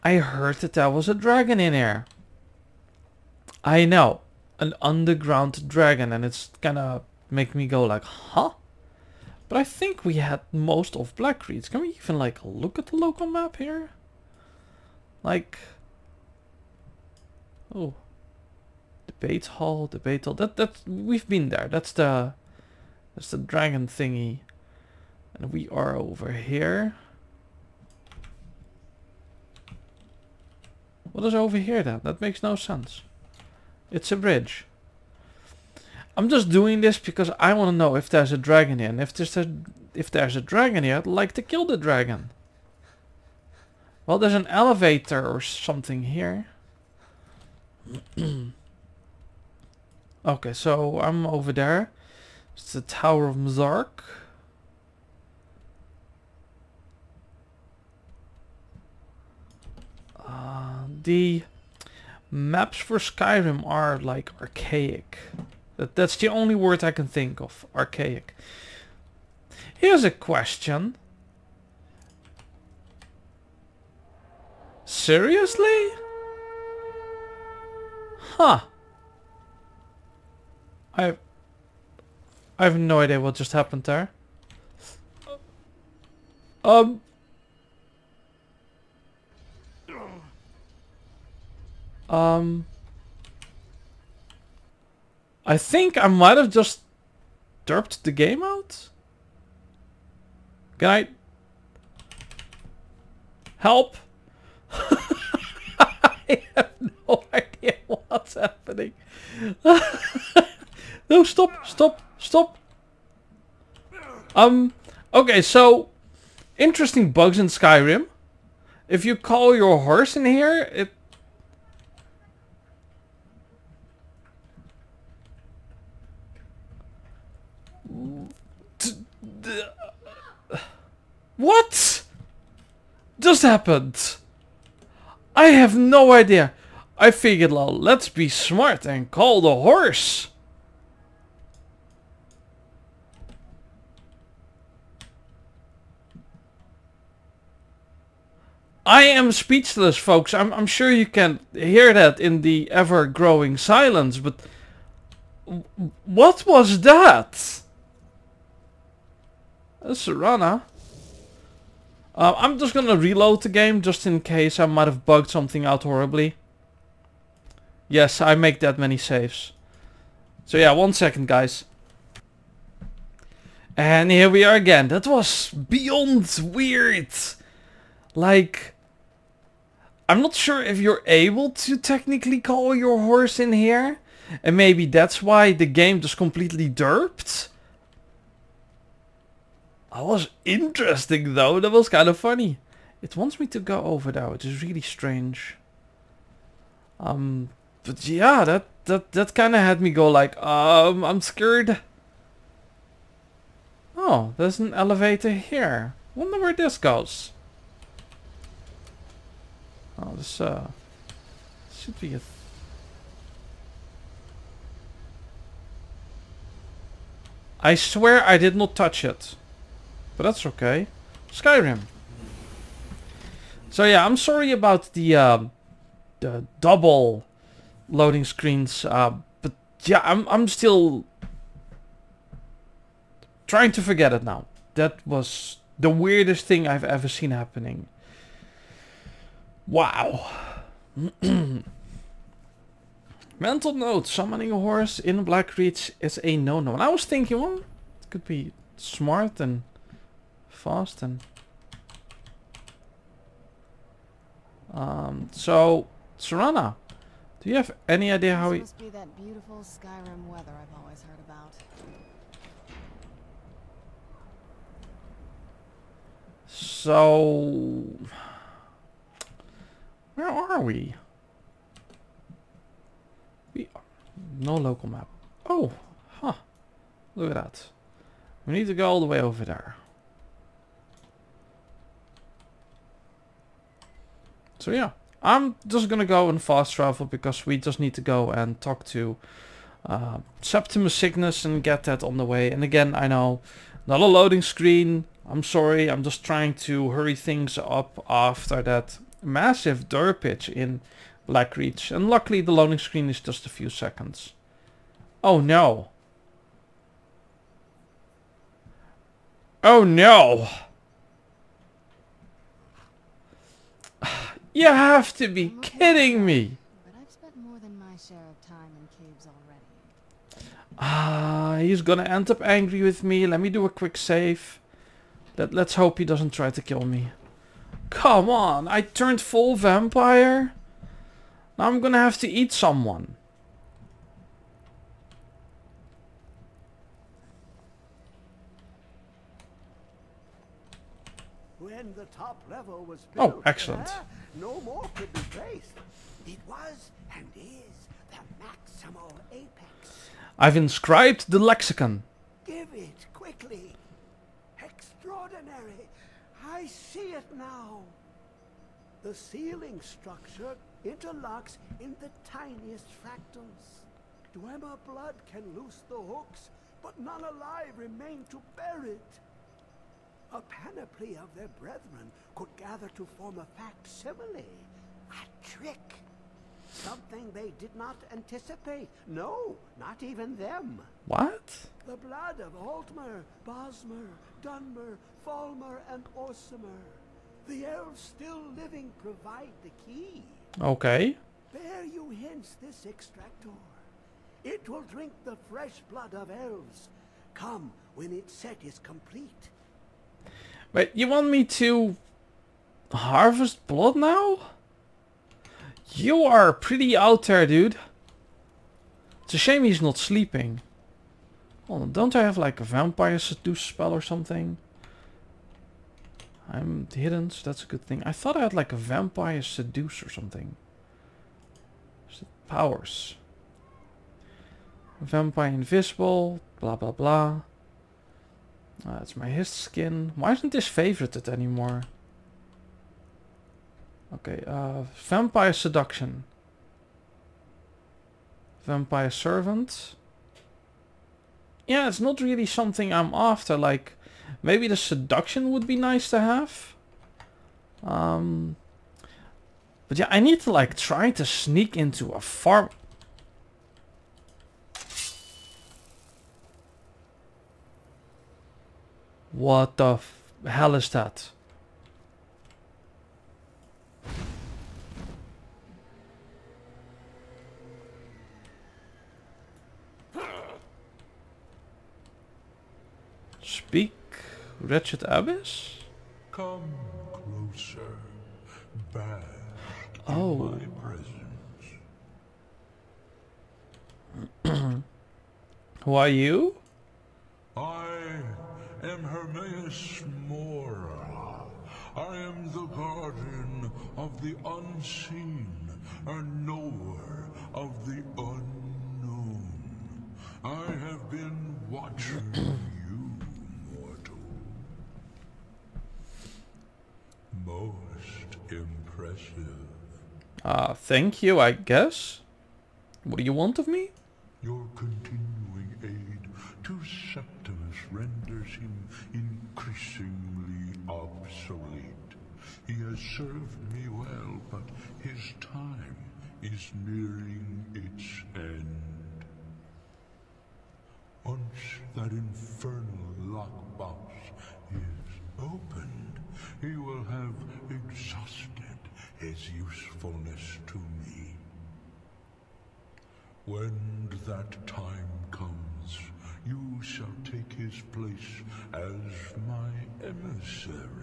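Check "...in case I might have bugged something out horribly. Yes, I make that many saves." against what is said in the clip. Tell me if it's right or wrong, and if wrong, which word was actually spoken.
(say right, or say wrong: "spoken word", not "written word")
right.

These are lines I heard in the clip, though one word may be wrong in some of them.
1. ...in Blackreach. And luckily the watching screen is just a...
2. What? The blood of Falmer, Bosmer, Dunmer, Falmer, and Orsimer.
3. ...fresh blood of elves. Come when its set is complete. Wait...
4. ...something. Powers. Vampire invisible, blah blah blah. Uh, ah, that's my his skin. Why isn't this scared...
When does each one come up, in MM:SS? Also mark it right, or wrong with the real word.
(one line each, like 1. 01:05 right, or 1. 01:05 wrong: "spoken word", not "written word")
1. 05:00 wrong: "loading", not "watching"
2. 06:21 wrong: "Altmer", not "Falmer"
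3. 06:35 right
4. 07:00 wrong: "favorited", not "scared".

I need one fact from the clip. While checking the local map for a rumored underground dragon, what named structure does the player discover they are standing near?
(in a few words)
Tower of Mzark.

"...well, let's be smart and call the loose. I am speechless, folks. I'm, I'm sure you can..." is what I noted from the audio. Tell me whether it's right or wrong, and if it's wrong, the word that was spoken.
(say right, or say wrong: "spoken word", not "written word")
wrong: "horse", not "loose".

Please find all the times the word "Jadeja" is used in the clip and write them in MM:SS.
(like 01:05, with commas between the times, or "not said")
not said.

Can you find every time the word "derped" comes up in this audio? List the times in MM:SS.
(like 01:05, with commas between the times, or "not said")
01:37, 03:06.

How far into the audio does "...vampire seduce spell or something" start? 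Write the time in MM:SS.
06:52.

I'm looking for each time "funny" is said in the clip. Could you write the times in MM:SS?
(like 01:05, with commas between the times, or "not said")
03:12.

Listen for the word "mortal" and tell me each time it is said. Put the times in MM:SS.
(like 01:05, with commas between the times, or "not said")
08:23.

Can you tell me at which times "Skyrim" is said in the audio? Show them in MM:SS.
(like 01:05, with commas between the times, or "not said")
01:02, 01:57, 03:41, 04:19.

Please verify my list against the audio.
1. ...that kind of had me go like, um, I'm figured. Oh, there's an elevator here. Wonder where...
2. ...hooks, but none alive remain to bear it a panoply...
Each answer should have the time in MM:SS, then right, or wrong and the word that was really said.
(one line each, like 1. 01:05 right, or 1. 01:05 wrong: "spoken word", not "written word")
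1. 03:19 wrong: "scared", not "figured"
2. 06:05 right.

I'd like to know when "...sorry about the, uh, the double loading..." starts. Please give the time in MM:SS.
03:44.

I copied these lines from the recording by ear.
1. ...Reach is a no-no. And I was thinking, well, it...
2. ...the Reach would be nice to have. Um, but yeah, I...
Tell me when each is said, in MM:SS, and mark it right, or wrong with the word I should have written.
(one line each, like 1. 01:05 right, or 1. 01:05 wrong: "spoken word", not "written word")
1. 04:05 right
2. 07:24 wrong: "Seduction", not "Reach".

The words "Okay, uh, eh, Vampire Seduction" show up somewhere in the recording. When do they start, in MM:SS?
07:14.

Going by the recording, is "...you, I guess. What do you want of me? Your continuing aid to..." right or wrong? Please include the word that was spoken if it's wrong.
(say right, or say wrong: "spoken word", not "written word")
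right.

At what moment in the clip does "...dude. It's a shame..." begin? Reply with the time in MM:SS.
06:47.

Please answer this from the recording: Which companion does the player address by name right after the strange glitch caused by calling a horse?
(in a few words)
Serana.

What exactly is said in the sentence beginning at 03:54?
That was the weirdest thing I've ever seen happening.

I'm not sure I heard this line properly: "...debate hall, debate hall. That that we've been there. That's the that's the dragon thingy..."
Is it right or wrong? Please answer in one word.
right.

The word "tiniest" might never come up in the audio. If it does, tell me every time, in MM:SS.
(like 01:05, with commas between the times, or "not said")
06:02.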